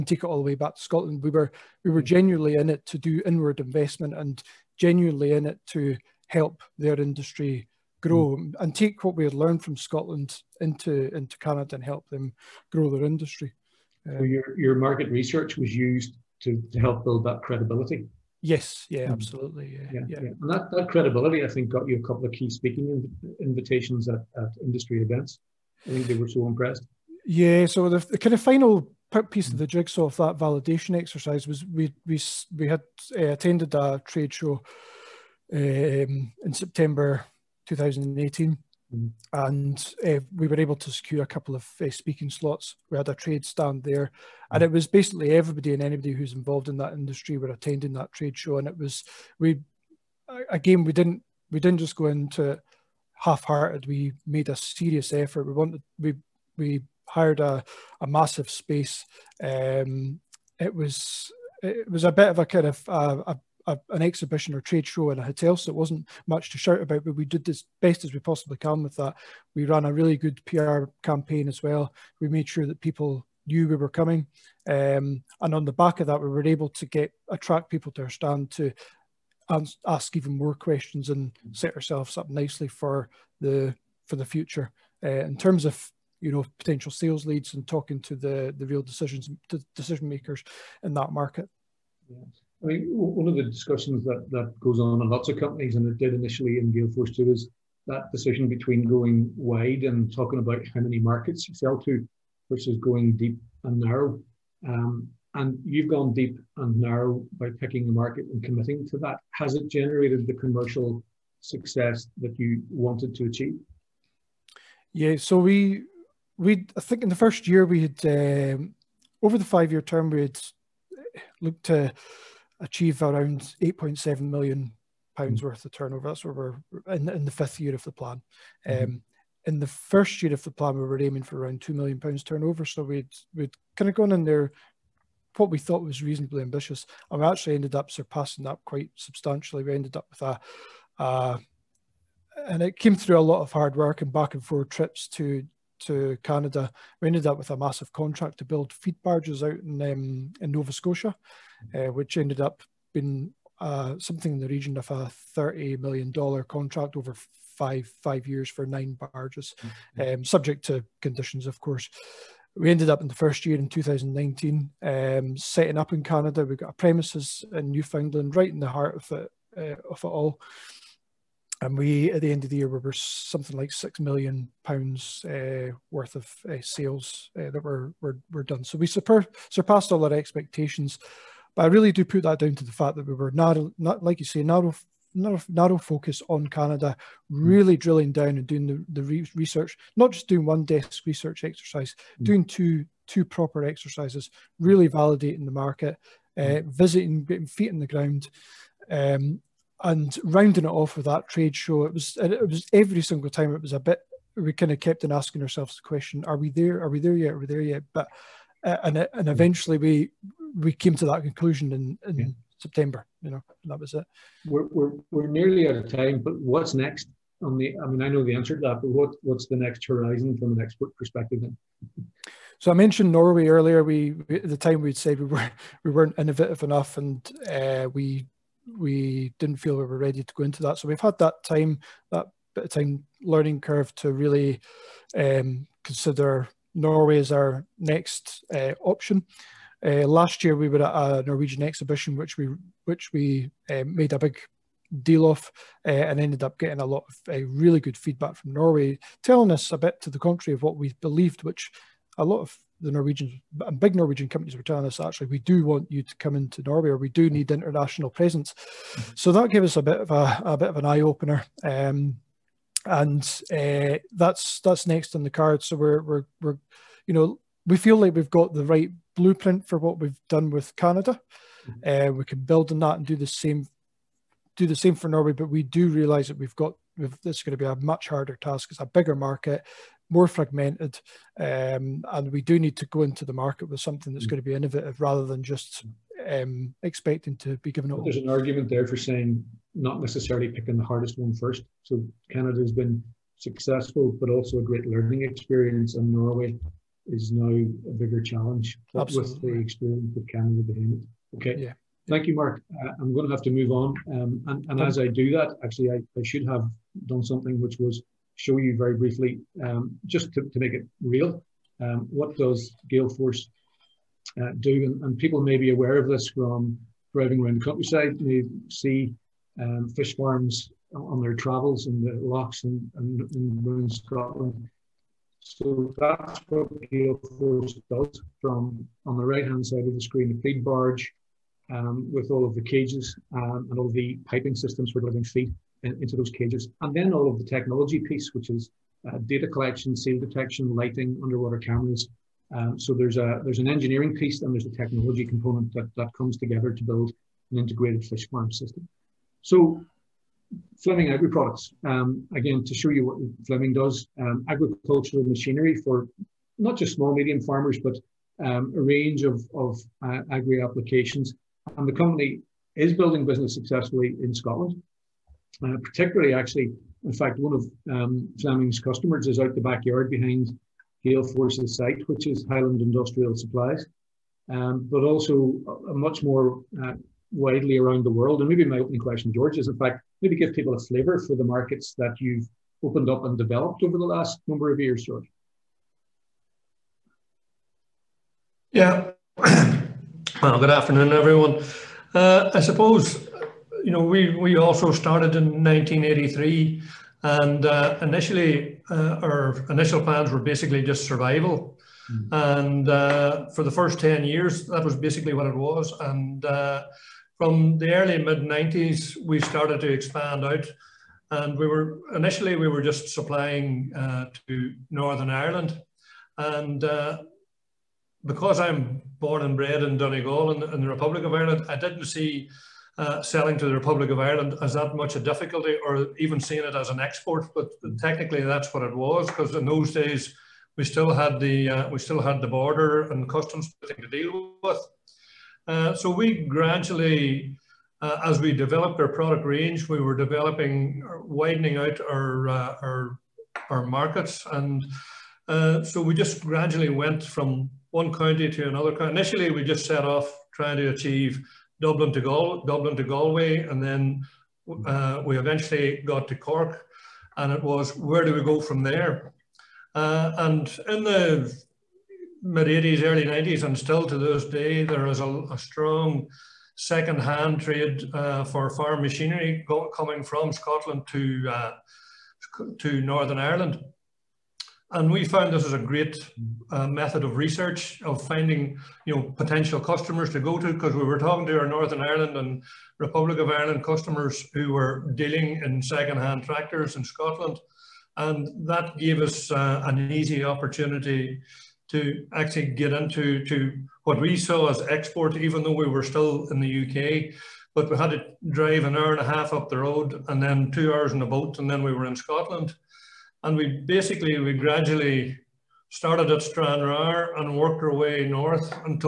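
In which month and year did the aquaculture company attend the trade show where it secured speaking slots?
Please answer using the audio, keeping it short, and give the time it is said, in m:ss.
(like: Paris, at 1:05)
September 2018, at 0:36.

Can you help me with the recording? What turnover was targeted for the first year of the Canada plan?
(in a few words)
2 million pounds.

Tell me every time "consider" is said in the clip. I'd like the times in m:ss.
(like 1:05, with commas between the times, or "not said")
3:55.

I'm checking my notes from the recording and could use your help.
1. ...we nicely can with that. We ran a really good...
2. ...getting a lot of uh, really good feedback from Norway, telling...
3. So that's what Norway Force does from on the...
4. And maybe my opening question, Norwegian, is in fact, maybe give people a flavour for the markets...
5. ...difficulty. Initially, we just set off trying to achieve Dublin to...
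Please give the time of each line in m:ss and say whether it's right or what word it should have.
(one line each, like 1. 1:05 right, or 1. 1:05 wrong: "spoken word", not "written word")
1. 1:08 wrong: "possibly", not "nicely"
2. 4:06 right
3. 5:25 wrong: "Gael", not "Norway"
4. 6:18 wrong: "George", not "Norwegian"
5. 7:28 wrong: "county", not "difficulty".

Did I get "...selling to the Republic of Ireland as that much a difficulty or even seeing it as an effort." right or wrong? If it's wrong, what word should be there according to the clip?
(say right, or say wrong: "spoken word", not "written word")
wrong: "export", not "effort".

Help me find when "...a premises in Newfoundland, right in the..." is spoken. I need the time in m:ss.
2:46.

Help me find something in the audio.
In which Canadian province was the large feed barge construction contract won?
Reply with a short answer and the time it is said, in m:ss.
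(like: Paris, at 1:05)
Nova Scotia, at 2:30.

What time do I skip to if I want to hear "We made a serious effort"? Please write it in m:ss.
0:53.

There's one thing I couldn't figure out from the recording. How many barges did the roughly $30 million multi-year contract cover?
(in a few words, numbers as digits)
9.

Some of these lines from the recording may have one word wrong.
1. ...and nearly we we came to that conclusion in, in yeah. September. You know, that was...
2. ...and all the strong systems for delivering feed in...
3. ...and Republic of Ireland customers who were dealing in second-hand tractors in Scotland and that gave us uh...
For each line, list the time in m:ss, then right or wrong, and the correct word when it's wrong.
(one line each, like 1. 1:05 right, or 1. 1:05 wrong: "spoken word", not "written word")
1. 3:29 wrong: "eventually", not "nearly"
2. 5:33 wrong: "piping", not "strong"
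3. 8:02 right.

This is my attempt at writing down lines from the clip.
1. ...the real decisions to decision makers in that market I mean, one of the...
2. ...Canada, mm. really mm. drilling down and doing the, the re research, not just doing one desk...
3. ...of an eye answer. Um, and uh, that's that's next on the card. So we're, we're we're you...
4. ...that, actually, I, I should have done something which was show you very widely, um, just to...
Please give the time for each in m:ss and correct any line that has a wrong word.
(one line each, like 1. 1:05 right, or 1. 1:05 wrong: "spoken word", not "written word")
1. 1:28 right
2. 3:06 right
3. 4:20 wrong: "opener", not "answer"
4. 5:05 wrong: "briefly", not "widely".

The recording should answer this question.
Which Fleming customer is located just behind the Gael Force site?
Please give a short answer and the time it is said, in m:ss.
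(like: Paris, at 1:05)
Highland Industrial Supplies, at 6:12.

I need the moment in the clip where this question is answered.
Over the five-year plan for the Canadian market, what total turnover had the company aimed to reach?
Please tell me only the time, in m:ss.
2:03.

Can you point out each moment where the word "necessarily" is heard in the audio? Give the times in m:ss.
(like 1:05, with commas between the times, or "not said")
4:49.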